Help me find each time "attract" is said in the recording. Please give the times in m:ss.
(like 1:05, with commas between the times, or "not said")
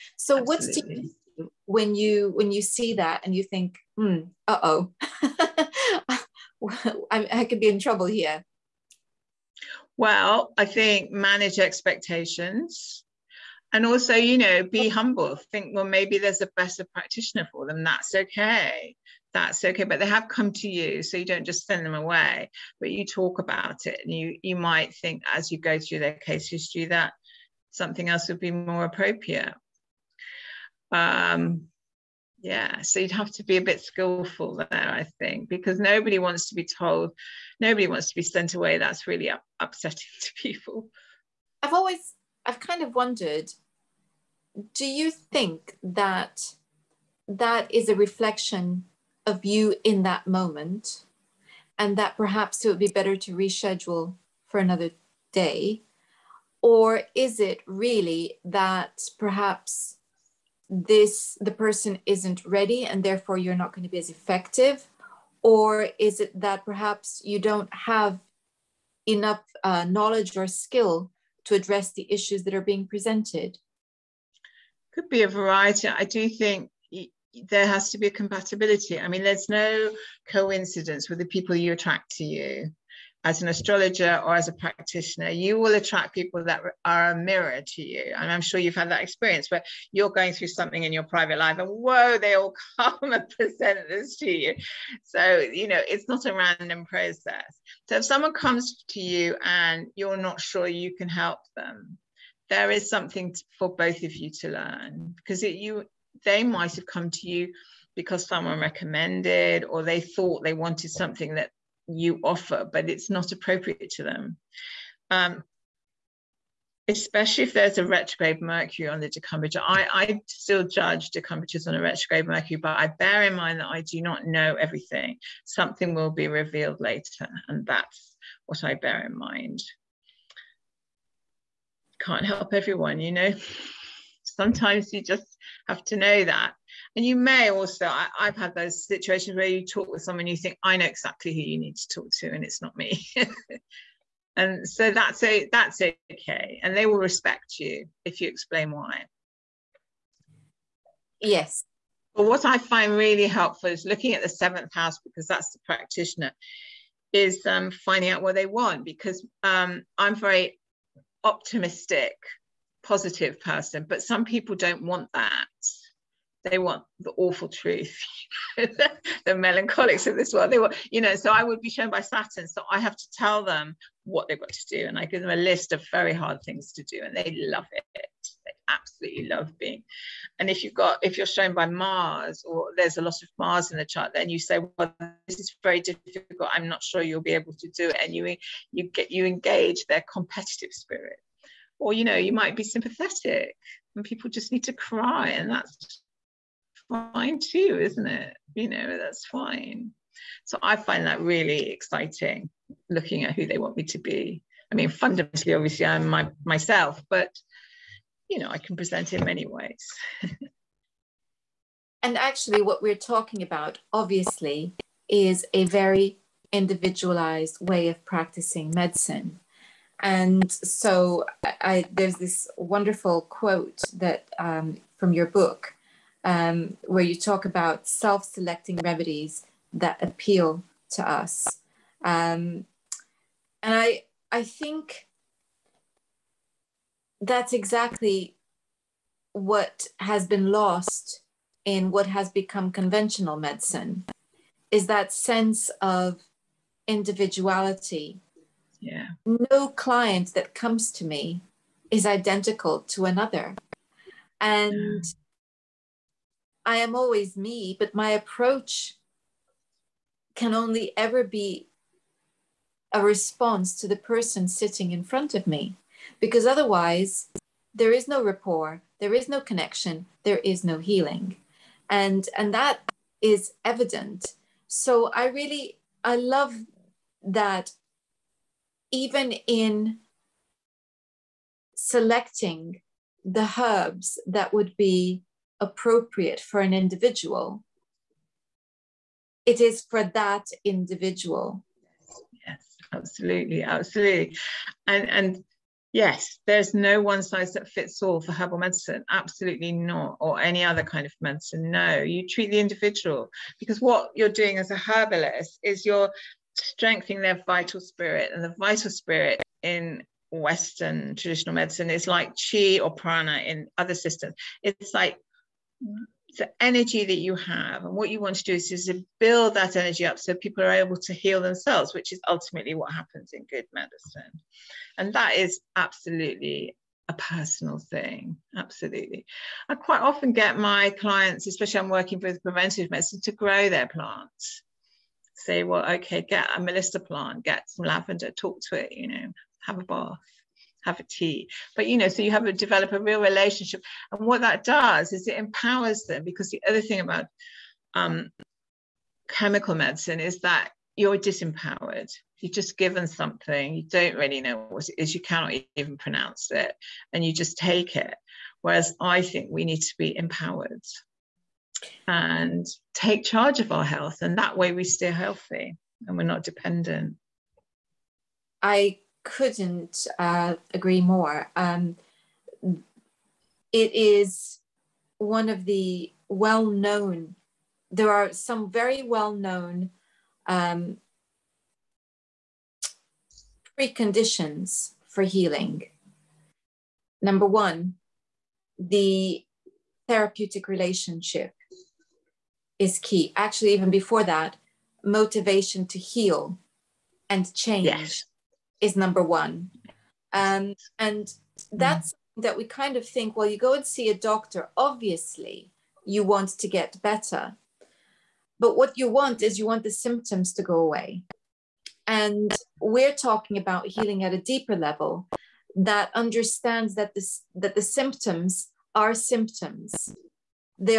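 1:21, 1:25.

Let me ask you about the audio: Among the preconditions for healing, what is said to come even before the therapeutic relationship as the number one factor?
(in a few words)
motivation to heal and change.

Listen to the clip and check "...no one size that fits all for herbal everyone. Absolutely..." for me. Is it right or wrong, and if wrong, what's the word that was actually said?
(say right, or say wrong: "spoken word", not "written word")
wrong: "medicine", not "everyone".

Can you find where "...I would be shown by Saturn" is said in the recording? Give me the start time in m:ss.
2:51.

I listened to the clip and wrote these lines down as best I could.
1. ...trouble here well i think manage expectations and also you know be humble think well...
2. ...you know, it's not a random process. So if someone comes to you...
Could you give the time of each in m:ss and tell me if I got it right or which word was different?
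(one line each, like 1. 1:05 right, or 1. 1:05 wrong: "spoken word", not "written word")
1. 0:07 right
2. 1:35 right.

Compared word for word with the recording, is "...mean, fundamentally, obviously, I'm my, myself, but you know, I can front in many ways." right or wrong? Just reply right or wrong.
wrong.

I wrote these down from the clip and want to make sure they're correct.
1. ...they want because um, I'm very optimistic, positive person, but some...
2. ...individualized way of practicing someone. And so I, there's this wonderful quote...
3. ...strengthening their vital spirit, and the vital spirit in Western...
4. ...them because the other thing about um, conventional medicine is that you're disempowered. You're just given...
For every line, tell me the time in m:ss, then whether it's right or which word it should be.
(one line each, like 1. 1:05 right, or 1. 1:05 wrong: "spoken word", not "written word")
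1. 2:38 right
2. 3:36 wrong: "medicine", not "someone"
3. 5:06 right
4. 5:46 wrong: "chemical", not "conventional".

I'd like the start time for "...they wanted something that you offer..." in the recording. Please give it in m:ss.
1:50.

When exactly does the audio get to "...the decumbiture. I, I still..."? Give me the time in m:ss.
1:58.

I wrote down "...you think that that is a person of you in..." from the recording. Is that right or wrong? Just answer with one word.
wrong.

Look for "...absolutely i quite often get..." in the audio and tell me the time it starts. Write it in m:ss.
5:28.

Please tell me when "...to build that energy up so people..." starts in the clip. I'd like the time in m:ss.
5:18.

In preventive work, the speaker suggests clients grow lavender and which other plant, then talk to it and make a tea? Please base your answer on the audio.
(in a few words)
melissa.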